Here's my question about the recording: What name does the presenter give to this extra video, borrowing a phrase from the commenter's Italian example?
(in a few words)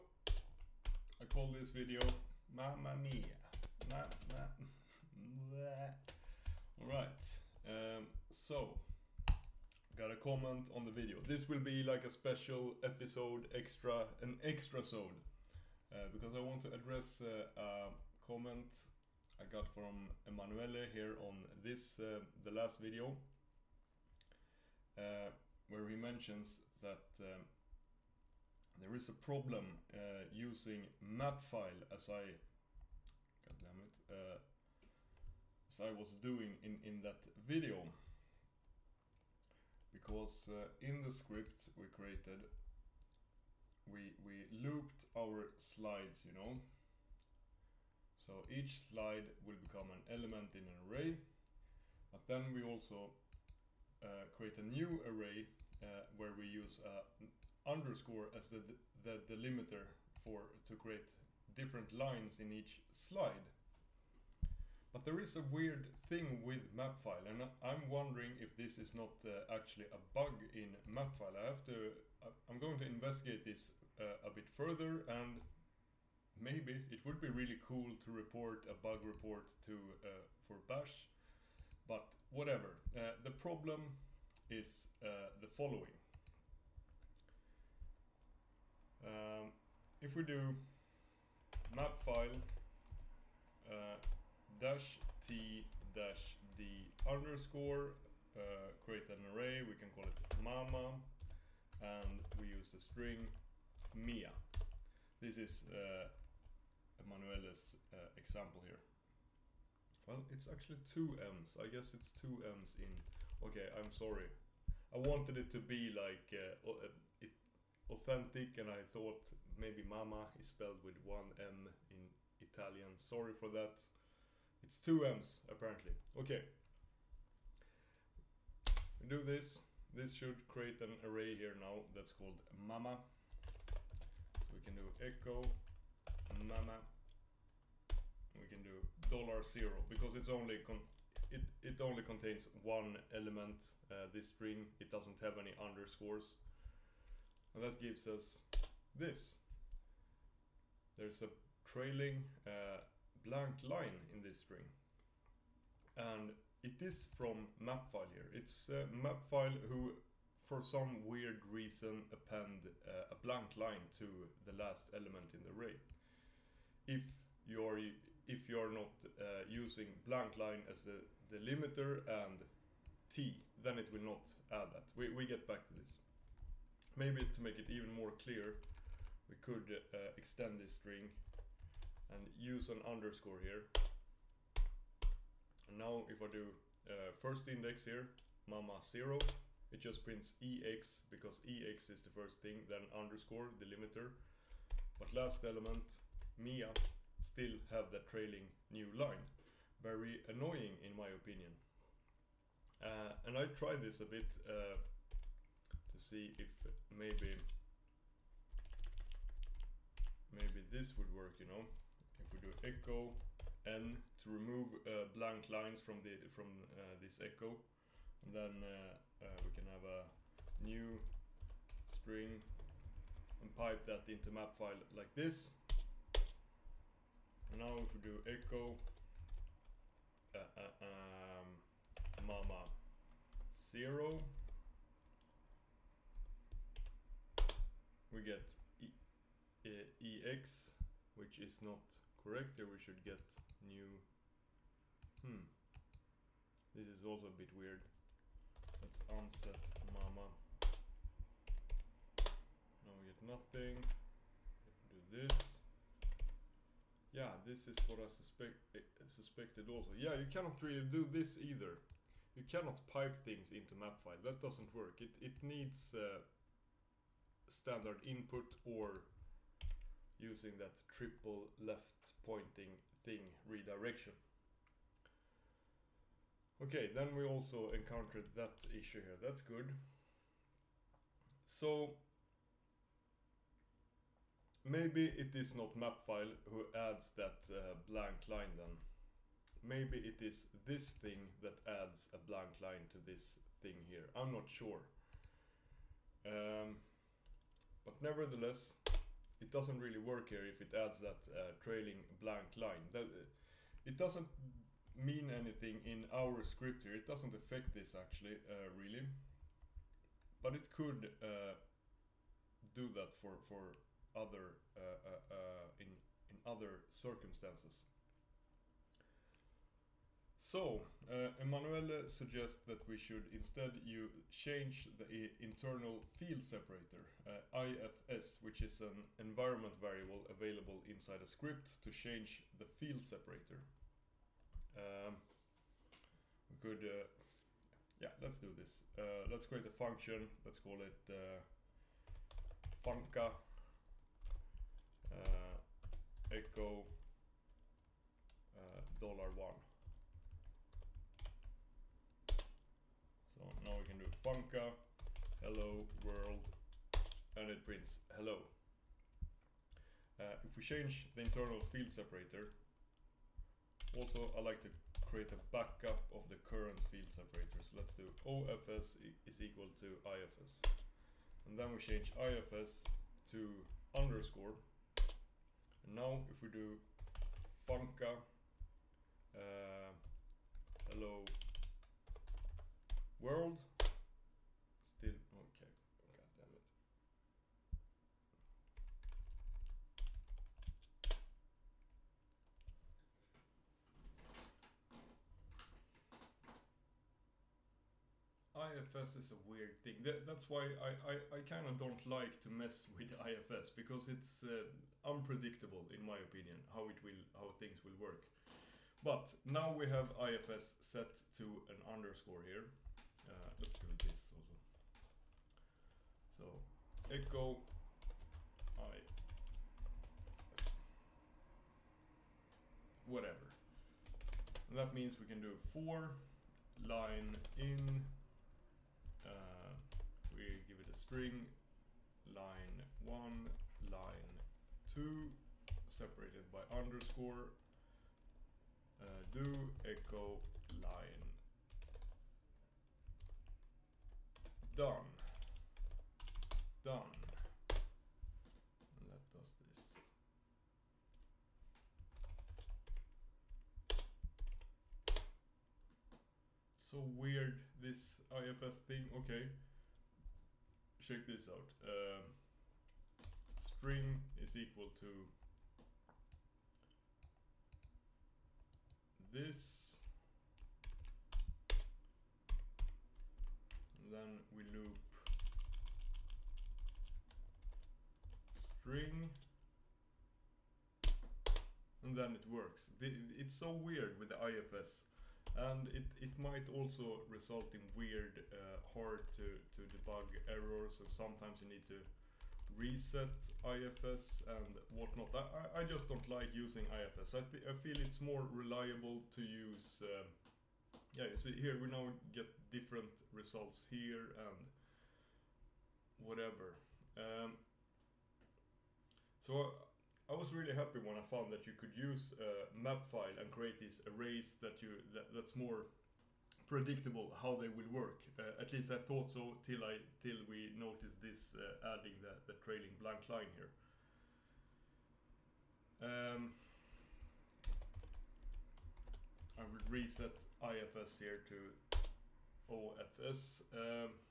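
Mamma Mia.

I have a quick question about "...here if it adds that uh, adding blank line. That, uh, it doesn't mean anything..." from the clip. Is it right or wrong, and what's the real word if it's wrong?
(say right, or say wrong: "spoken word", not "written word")
wrong: "trailing", not "adding".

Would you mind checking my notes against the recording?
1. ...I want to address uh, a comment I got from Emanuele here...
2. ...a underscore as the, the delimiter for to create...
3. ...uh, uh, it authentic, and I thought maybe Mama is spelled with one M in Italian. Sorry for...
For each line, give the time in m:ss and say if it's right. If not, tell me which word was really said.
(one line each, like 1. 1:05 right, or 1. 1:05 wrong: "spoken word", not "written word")
1. 0:16 right
2. 0:56 right
3. 1:56 right.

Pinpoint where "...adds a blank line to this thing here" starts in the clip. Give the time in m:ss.
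4:51.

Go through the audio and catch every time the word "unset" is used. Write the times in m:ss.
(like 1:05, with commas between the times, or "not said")
4:09.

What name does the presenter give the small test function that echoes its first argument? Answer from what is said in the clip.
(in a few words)
funca.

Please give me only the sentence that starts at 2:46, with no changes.
If you're if you're not uh, using blank line as the delimiter and t, then it will not add that.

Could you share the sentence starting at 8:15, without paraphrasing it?
I, I just don't like using IFS.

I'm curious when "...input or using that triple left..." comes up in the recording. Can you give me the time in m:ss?
4:28.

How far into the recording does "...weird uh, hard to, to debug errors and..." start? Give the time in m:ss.
8:07.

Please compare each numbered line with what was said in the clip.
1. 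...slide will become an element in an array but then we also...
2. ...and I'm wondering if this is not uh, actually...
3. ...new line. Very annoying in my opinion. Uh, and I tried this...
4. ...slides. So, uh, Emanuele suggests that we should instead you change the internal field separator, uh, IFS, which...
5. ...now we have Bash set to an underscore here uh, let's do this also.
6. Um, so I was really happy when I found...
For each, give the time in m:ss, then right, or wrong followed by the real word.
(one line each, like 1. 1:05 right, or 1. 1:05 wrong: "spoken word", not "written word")
1. 0:48 right
2. 1:07 right
3. 3:18 right
4. 5:16 wrong: "circumstances", not "slides"
5. 6:49 wrong: "IFS", not "Bash"
6. 8:27 right.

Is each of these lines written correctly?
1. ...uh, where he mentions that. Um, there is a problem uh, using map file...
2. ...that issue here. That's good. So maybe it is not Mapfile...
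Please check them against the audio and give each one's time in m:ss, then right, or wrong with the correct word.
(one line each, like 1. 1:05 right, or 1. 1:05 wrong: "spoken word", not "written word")
1. 0:24 right
2. 4:38 right.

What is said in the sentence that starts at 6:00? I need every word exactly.
Uh, if we change the internal field separator, also I like to create a backup of the current field separator.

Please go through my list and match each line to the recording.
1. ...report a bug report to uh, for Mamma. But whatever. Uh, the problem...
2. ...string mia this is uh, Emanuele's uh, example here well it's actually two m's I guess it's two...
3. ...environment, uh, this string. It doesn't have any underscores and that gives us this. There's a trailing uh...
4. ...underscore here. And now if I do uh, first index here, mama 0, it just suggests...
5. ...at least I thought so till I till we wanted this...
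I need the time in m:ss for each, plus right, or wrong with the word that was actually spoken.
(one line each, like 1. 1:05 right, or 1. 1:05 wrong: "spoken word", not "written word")
1. 1:18 wrong: "Bash", not "Mamma"
2. 1:42 right
3. 2:23 wrong: "element", not "environment"
4. 3:02 wrong: "prints", not "suggests"
5. 8:38 wrong: "noticed", not "wanted".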